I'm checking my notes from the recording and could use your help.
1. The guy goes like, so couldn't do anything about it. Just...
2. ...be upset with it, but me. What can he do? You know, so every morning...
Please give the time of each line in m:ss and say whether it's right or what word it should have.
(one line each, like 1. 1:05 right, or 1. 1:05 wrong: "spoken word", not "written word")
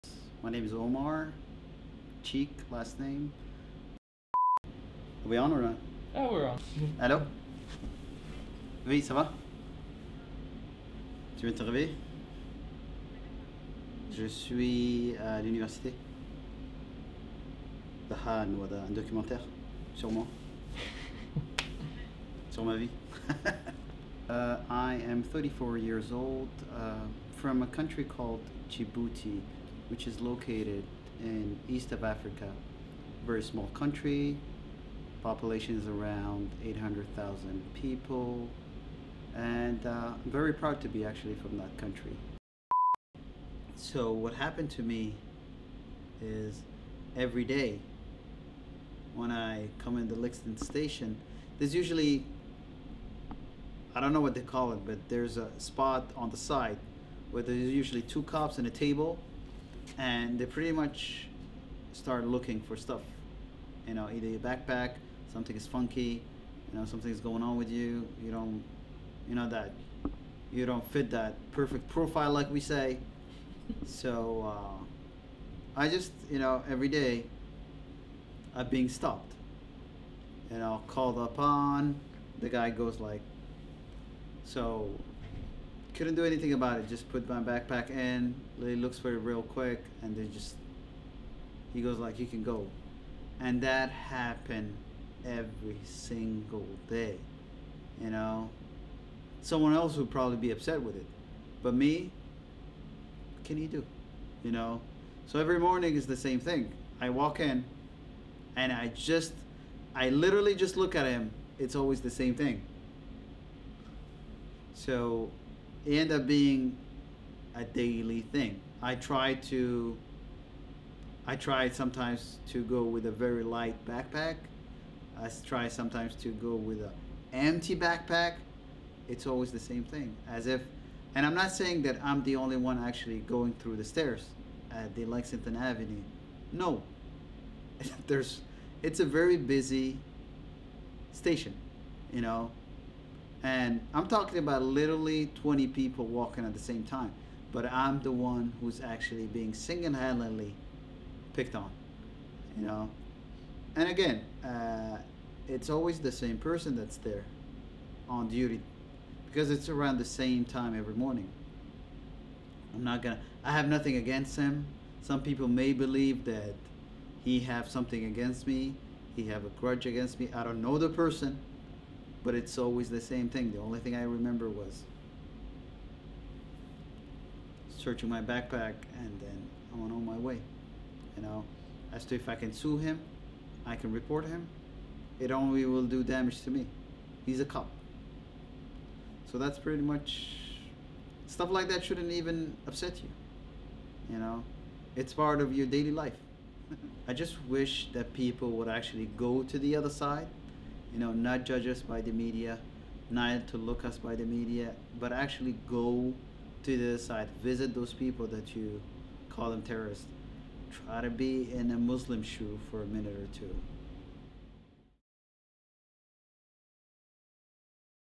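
1. 1:22 right
2. 1:40 right.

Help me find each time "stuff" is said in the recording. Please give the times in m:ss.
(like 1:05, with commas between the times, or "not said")
1:02, 3:11.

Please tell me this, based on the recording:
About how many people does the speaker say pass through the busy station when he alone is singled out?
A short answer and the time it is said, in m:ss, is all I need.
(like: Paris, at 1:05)
20, at 2:25.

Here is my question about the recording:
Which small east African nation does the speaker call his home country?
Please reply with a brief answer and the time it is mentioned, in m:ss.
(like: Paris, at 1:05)
Djibouti, at 0:28.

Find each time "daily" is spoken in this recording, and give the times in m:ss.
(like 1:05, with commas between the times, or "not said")
1:57, 3:15.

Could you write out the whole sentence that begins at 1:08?
You don't, you know that, you don't fit that perfect profile like we say.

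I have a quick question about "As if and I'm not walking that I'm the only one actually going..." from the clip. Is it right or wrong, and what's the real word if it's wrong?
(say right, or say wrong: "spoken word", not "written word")
wrong: "saying", not "walking".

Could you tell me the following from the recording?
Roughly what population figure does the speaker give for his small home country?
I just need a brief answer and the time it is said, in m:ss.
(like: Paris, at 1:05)
800,000, at 0:36.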